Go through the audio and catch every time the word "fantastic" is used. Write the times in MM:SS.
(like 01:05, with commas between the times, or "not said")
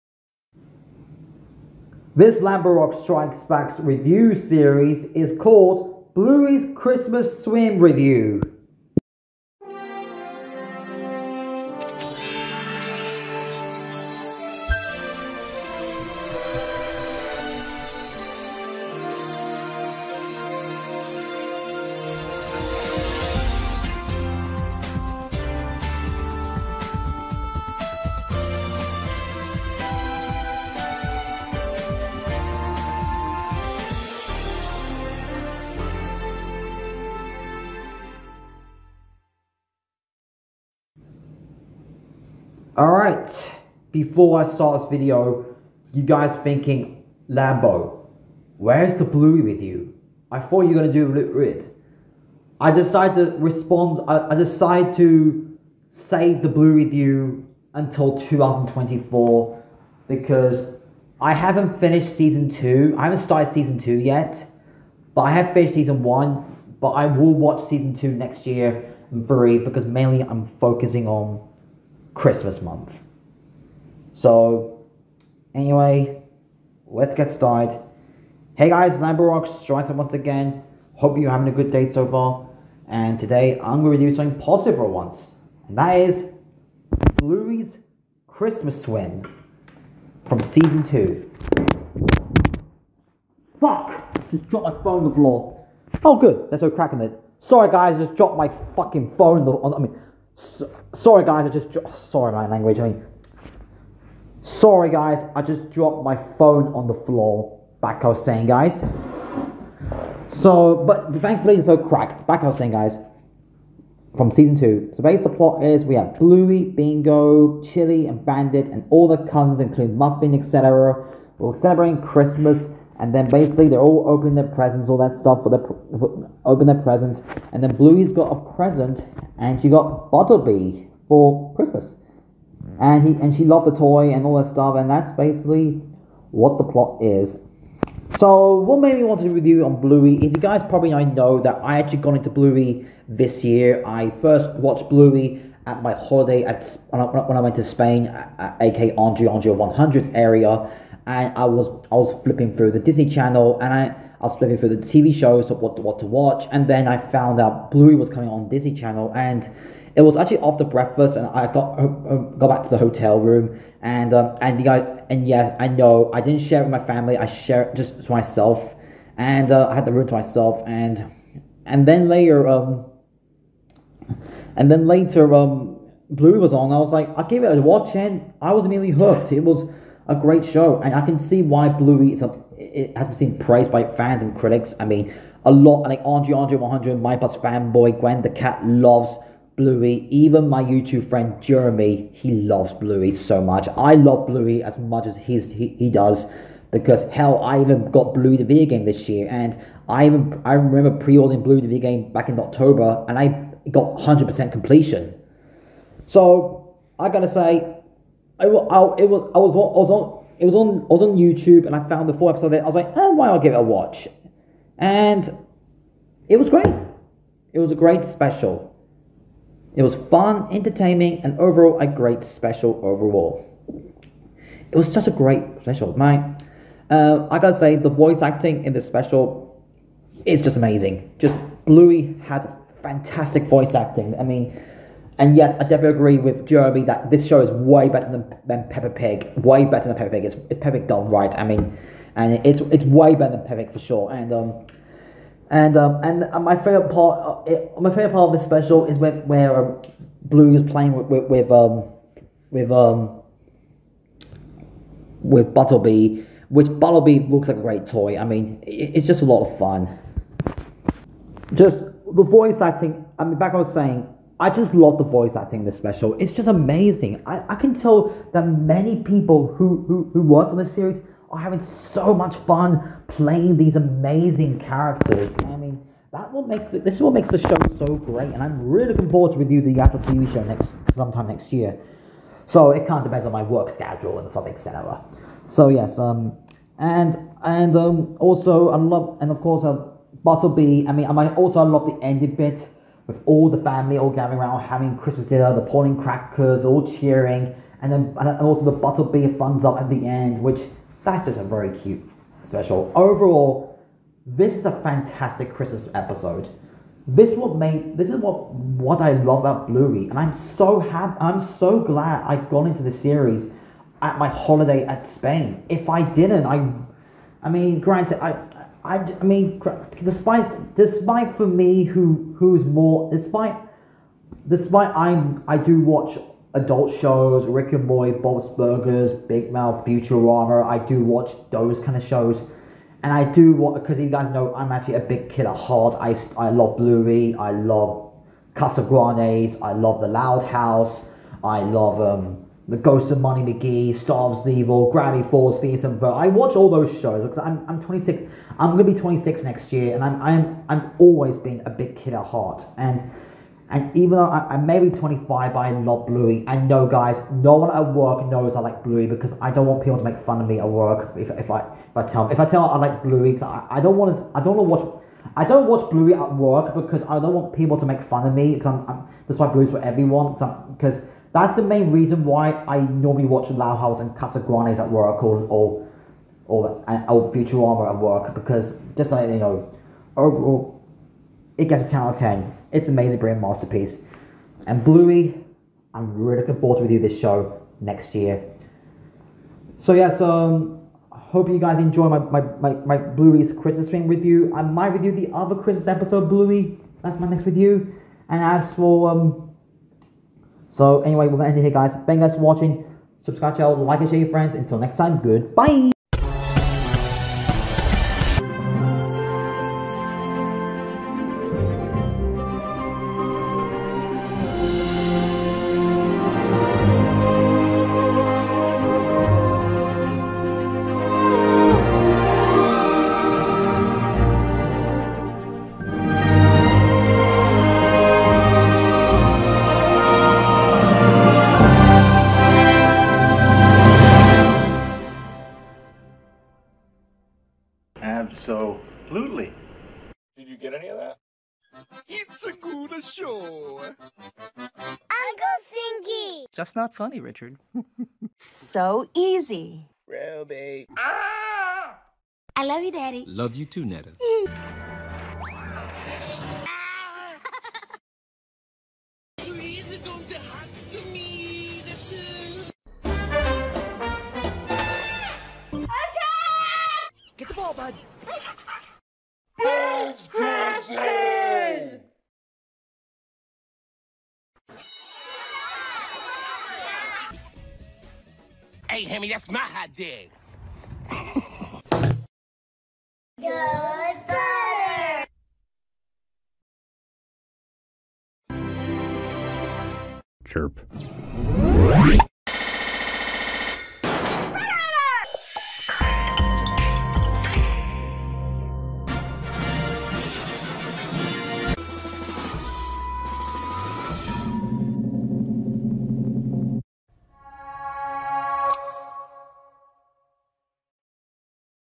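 03:52, 05:04.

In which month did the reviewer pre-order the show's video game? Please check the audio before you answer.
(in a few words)
October.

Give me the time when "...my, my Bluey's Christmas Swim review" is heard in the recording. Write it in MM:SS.
06:32.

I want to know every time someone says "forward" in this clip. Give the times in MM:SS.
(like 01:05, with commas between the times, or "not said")
04:39, 06:26.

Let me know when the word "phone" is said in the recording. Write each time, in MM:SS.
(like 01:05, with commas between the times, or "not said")
01:34, 01:39, 01:46.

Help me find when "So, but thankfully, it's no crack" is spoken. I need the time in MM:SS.
01:50.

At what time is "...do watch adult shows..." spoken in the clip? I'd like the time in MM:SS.
05:25.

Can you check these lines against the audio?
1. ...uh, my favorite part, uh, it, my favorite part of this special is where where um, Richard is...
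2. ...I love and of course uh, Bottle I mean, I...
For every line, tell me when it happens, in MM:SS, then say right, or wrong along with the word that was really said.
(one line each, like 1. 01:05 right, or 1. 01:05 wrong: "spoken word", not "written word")
1. 04:06 wrong: "Blue", not "Richard"
2. 04:48 right.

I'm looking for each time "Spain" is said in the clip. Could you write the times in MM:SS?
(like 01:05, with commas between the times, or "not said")
02:27, 05:15.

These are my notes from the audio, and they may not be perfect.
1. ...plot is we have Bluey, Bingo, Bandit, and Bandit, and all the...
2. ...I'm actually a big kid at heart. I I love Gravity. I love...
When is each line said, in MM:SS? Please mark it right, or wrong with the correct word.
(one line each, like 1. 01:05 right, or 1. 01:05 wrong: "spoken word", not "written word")
1. 01:55 wrong: "Chili", not "Bandit"
2. 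05:34 wrong: "Bluey", not "Gravity".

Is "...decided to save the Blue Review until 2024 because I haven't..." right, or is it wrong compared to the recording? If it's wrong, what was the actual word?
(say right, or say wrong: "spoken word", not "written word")
right.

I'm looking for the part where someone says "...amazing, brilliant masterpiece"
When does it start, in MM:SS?
06:22.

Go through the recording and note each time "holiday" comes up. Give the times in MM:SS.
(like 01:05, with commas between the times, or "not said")
02:25, 05:14.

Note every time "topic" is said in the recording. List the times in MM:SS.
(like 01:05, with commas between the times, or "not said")
not said.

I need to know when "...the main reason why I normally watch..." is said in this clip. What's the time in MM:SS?
06:11.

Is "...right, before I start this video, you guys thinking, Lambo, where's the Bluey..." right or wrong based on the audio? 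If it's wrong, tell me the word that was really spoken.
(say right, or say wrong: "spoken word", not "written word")
right.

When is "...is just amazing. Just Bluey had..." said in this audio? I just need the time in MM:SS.
03:50.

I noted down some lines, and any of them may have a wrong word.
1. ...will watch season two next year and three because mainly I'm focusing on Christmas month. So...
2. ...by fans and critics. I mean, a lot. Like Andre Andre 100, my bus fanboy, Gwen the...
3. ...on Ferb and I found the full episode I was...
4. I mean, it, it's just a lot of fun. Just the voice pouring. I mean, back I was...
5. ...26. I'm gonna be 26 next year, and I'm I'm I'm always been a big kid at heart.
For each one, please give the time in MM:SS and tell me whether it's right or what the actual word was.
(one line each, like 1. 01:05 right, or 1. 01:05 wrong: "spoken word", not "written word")
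1. 01:07 right
2. 03:03 right
3. 03:31 wrong: "YouTube", not "Ferb"
4. 04:18 wrong: "acting", not "pouring"
5. 05:47 right.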